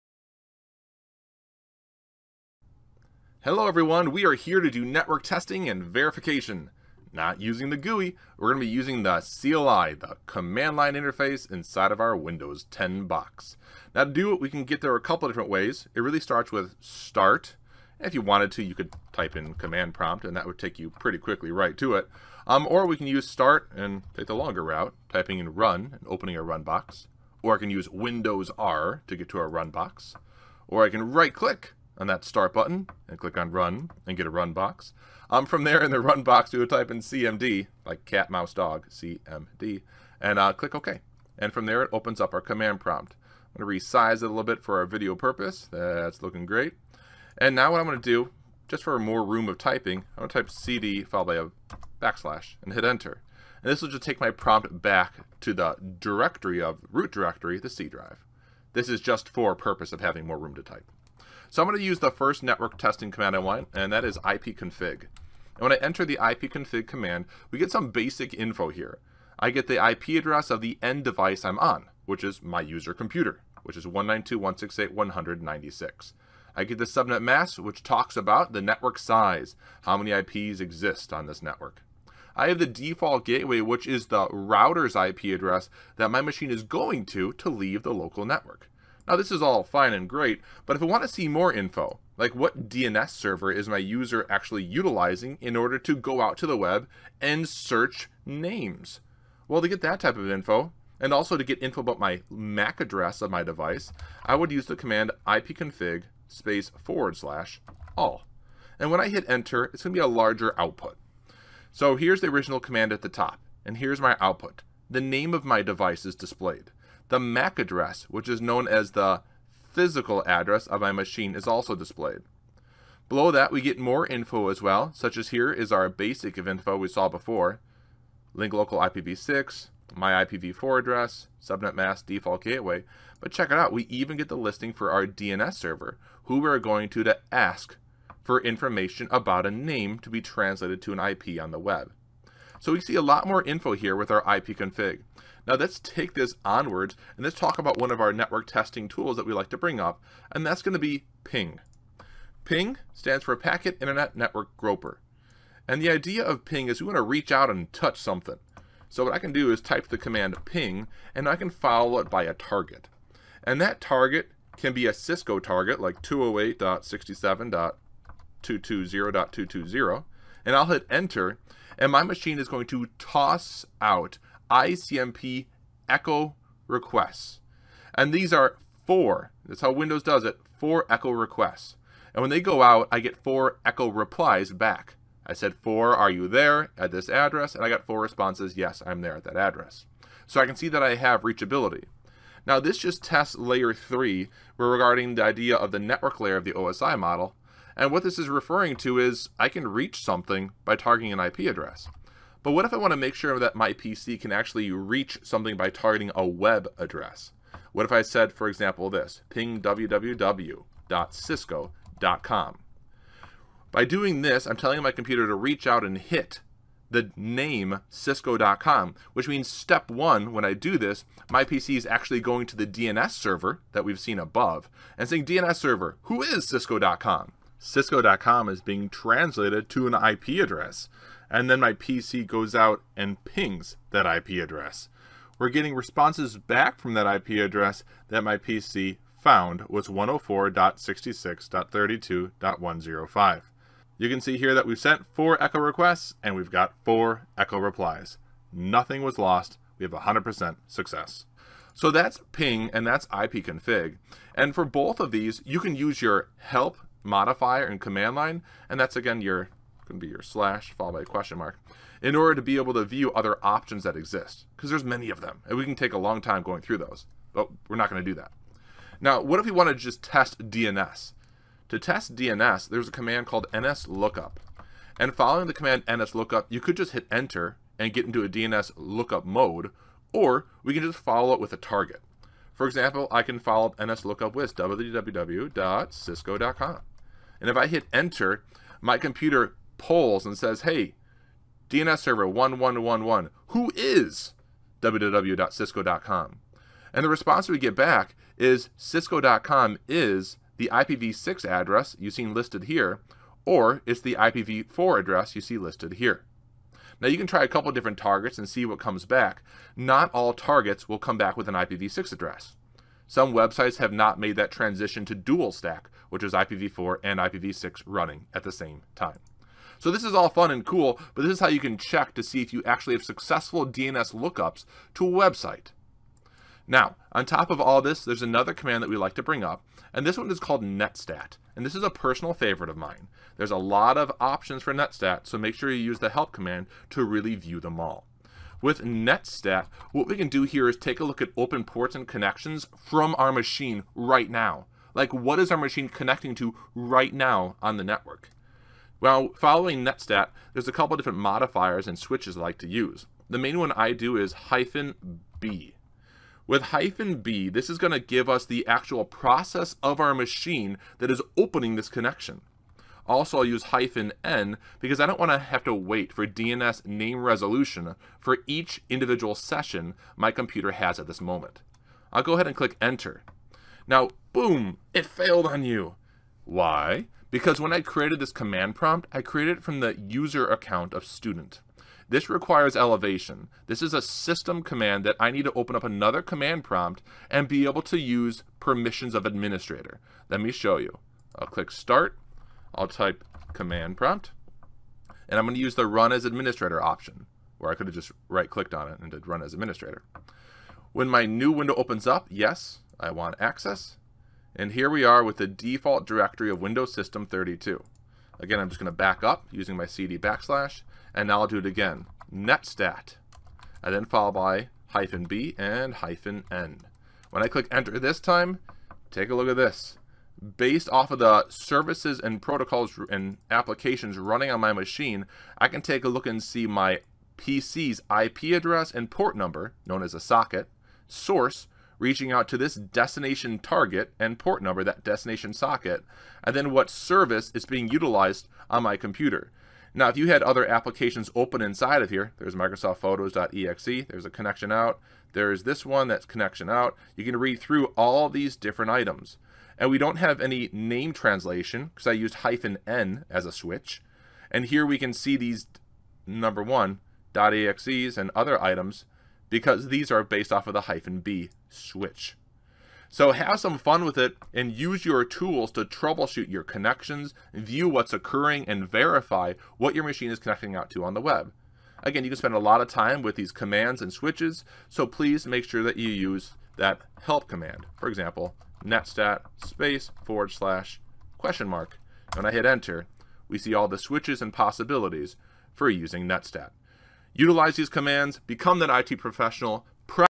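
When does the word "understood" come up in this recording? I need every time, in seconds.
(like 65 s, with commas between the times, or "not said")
not said.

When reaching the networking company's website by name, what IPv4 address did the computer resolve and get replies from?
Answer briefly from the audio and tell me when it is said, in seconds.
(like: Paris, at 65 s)
104.66.32.105, at 239 s.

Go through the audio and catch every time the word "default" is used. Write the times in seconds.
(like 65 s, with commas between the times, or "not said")
82 s, 132 s, 405 s.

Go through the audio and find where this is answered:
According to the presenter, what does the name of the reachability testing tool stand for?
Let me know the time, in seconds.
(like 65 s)
153 s.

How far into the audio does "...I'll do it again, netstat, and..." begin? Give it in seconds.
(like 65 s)
411 s.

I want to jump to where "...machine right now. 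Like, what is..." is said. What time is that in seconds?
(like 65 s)
343 s.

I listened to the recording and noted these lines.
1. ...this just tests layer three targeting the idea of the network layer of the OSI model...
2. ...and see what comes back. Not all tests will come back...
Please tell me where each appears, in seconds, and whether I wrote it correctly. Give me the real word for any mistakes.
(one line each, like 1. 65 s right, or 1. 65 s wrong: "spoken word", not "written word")
1. 192 s wrong: "regarding", not "targeting"
2. 308 s wrong: "targets", not "tests".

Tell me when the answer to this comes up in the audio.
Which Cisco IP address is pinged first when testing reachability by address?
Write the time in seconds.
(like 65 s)
166 s.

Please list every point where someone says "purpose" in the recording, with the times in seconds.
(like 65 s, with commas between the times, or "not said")
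45 s, 59 s.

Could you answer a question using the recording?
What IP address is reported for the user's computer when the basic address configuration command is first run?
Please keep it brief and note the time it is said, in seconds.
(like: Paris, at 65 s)
192.168.196, at 73 s.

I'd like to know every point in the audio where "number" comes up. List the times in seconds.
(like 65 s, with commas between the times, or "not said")
429 s, 434 s, 456 s.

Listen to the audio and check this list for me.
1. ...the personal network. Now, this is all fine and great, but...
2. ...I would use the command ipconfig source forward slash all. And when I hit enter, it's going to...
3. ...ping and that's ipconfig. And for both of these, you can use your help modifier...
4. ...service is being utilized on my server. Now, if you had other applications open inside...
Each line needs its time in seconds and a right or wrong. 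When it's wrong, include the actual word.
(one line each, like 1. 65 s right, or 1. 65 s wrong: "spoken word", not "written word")
1. 87 s wrong: "local", not "personal"
2. 104 s wrong: "space", not "source"
3. 252 s right
4. 436 s wrong: "computer", not "server".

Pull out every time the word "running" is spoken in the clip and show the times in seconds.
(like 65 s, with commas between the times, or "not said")
317 s, 424 s.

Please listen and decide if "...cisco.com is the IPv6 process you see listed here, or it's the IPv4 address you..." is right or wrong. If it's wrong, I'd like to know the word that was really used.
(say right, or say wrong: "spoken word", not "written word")
wrong: "address", not "process".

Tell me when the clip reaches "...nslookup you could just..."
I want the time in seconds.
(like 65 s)
275 s.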